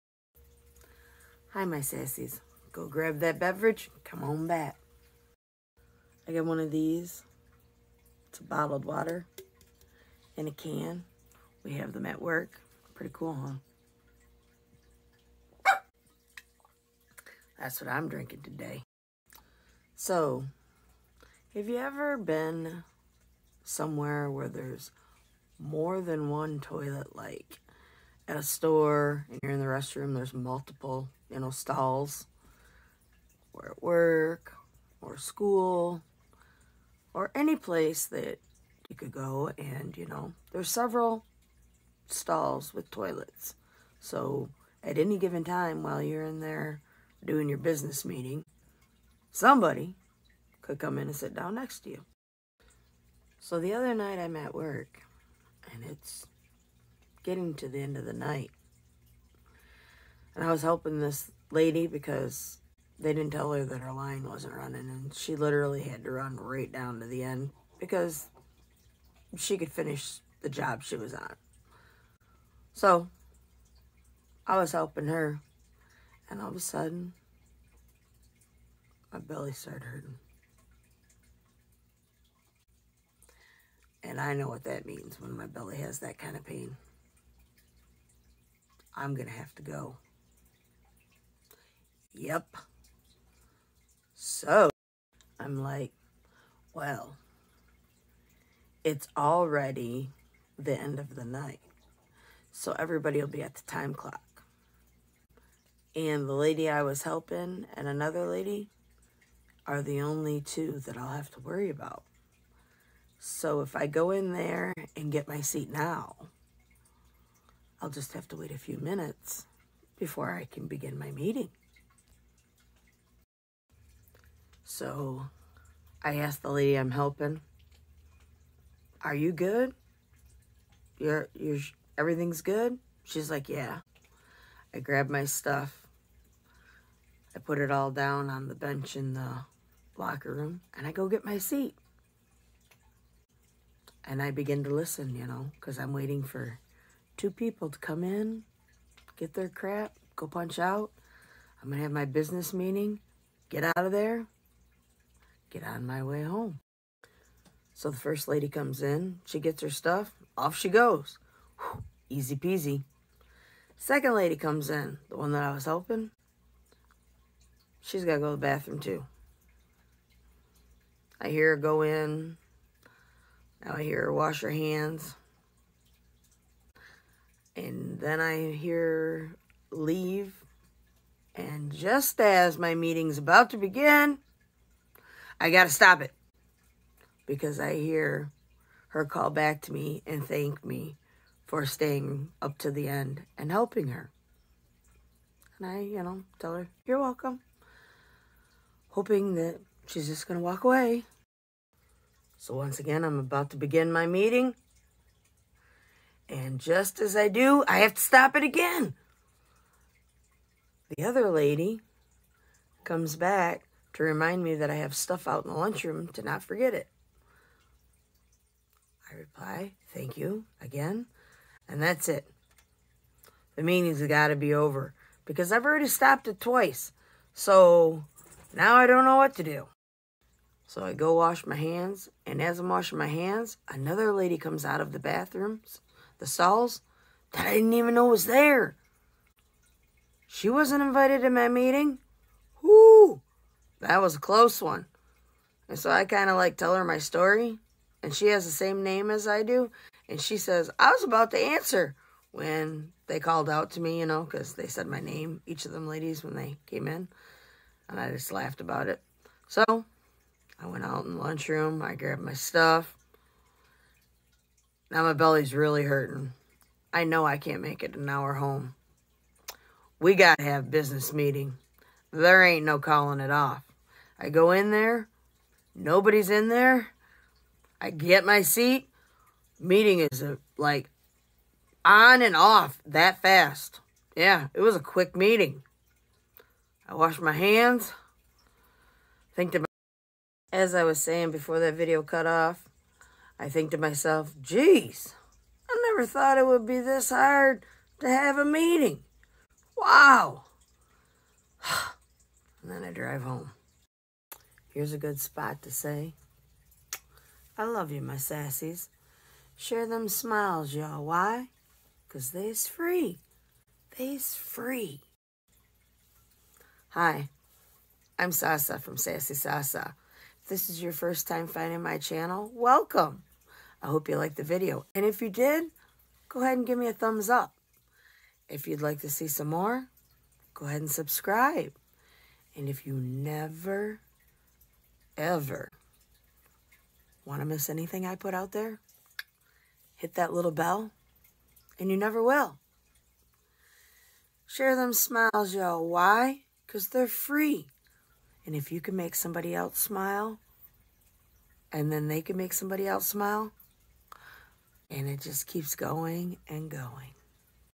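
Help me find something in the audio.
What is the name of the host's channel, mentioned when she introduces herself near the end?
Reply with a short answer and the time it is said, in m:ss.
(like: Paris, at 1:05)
Sassy Sasa, at 5:18.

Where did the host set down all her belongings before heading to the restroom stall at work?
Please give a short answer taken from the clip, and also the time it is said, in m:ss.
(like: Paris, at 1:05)
On the bench in the locker room, at 2:18.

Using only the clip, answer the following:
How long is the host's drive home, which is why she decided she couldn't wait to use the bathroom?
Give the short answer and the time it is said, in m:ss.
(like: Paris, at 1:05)
An hour, at 4:27.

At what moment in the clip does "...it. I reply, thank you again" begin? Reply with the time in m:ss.
3:36.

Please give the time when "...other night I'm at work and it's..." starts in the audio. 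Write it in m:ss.
0:53.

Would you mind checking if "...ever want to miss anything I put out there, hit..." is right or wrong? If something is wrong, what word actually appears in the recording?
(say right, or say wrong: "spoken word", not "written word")
right.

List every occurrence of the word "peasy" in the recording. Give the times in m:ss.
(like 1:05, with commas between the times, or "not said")
2:42.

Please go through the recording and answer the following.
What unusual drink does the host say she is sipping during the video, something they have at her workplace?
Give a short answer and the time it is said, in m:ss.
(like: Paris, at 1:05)
Bottled water in a can, at 0:08.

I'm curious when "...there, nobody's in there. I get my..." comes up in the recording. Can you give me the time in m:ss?
4:34.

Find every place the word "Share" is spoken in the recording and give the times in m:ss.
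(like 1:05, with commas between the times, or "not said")
5:09, 5:44.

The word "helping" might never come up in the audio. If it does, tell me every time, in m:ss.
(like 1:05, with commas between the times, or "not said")
1:00, 1:14, 1:47, 2:06, 2:45, 3:13.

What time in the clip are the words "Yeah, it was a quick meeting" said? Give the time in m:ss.
4:44.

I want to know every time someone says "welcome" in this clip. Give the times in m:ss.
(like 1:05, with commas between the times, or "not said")
3:16, 5:22.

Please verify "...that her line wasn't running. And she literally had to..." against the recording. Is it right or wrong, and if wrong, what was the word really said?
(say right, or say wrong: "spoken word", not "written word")
right.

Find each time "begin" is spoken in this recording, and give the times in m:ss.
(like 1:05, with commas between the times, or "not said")
2:00, 2:24, 3:03, 3:23.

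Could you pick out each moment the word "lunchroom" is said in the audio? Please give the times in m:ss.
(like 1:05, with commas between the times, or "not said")
3:35, 4:21.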